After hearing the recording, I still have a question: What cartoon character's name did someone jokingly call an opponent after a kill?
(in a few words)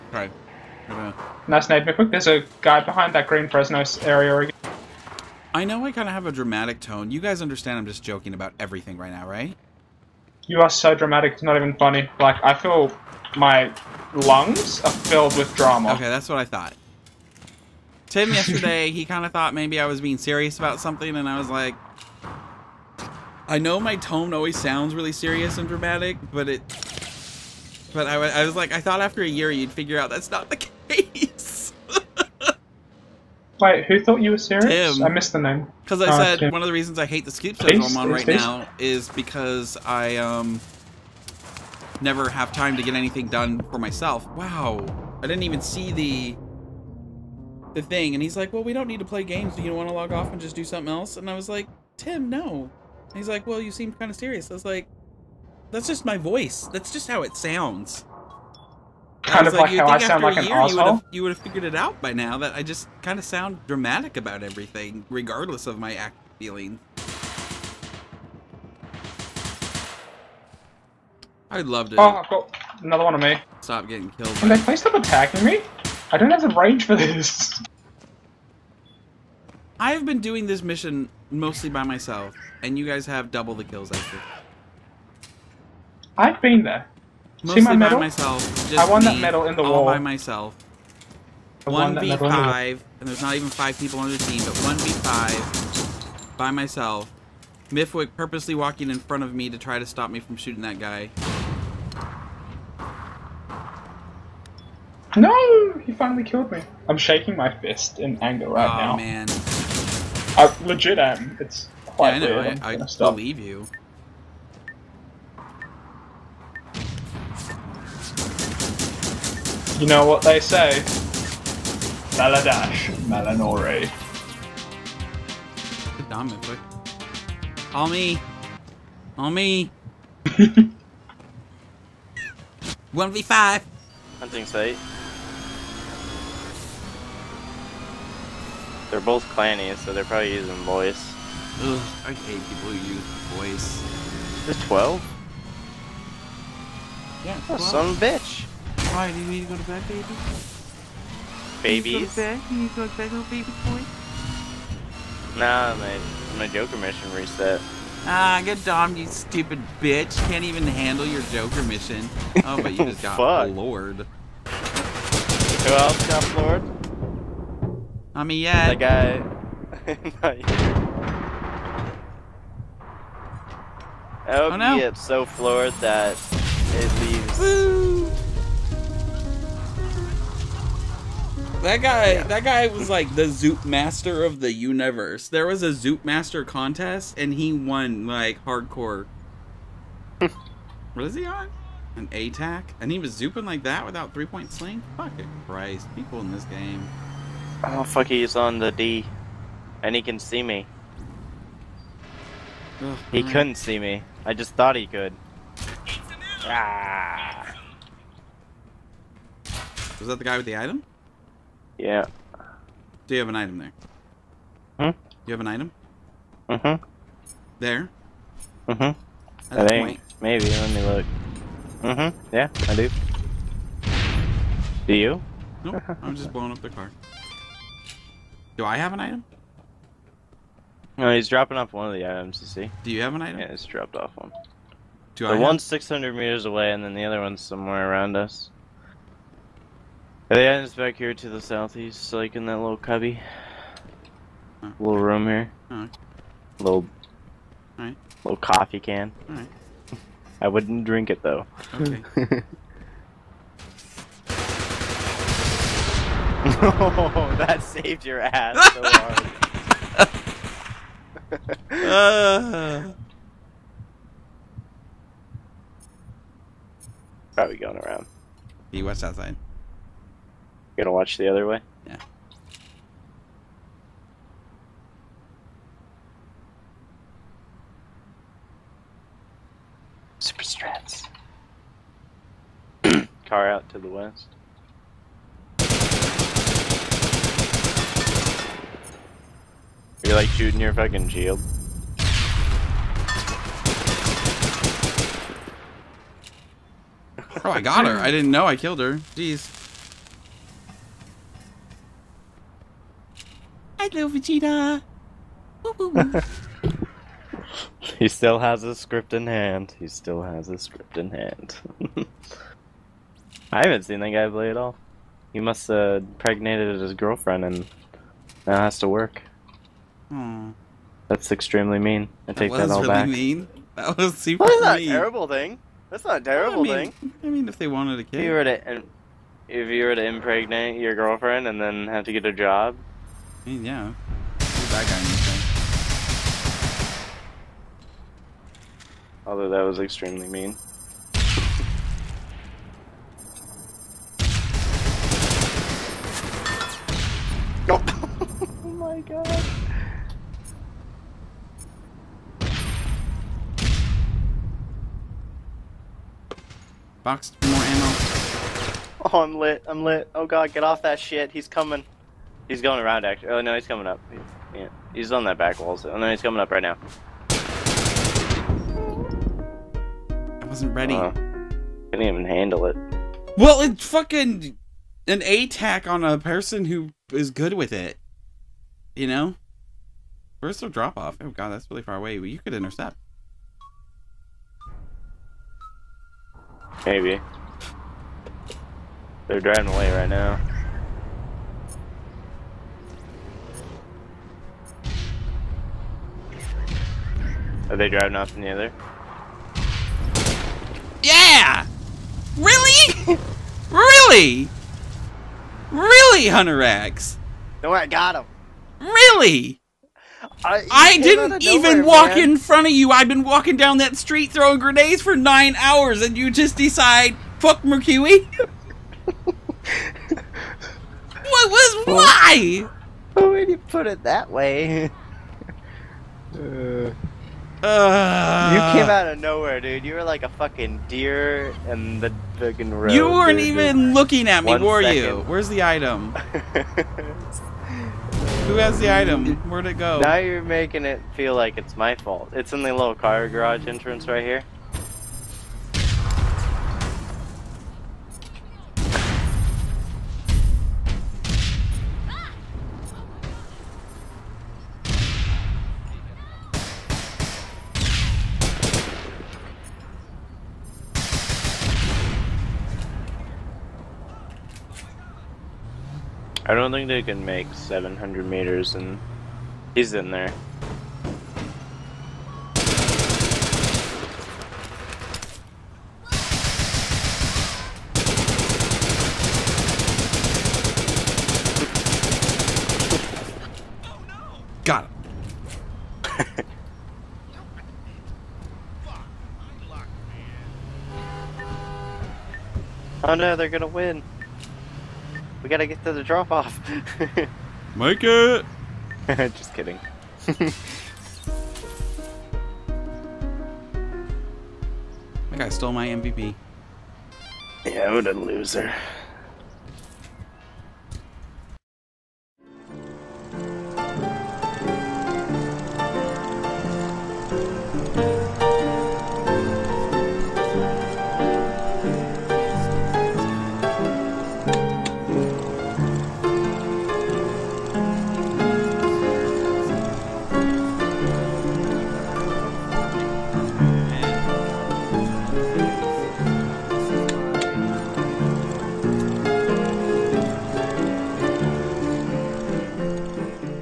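Vegeta.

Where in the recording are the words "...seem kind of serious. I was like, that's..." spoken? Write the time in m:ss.
0:53.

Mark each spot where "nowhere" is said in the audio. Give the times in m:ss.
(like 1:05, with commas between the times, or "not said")
6:51, 7:09.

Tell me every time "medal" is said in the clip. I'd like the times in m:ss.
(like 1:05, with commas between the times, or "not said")
1:29.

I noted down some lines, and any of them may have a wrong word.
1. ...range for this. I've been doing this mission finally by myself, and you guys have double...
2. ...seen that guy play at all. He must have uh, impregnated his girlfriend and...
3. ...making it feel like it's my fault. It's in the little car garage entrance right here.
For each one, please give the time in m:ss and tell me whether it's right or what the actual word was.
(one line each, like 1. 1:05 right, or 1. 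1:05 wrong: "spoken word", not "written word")
1. 1:16 wrong: "mostly", not "finally"
2. 5:13 right
3. 7:20 right.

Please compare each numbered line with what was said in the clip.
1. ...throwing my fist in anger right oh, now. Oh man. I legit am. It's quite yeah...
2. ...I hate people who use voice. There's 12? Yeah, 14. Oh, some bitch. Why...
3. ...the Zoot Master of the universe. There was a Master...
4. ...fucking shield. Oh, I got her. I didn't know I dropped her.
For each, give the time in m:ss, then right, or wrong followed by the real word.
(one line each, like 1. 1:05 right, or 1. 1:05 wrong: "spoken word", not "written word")
1. 1:46 wrong: "shaking", not "throwing"
2. 2:22 wrong: "12", not "14"
3. 3:03 wrong: "Zoot", not "Master"
4. 4:50 wrong: "killed", not "dropped".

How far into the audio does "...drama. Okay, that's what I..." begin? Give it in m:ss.
0:15.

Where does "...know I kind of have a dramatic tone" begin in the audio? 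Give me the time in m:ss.
0:05.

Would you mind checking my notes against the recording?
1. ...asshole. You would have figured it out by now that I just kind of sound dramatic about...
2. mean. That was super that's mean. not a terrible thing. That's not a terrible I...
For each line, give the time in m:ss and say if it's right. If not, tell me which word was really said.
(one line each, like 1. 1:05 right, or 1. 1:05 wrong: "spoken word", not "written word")
1. 1:00 right
2. 5:23 right.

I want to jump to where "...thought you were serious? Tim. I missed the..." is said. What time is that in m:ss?
0:34.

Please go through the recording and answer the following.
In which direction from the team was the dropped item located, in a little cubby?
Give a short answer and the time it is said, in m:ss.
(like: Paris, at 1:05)
southeast, at 4:01.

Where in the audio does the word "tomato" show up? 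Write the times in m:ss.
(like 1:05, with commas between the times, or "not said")
not said.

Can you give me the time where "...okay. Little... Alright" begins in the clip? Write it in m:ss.
4:05.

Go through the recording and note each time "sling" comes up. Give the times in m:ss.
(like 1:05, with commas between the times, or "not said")
3:14.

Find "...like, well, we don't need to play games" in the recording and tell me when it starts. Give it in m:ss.
0:48.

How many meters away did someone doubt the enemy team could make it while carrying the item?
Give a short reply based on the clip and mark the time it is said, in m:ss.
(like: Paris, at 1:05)
700, at 7:47.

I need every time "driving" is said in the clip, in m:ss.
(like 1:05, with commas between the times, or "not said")
6:29, 6:37.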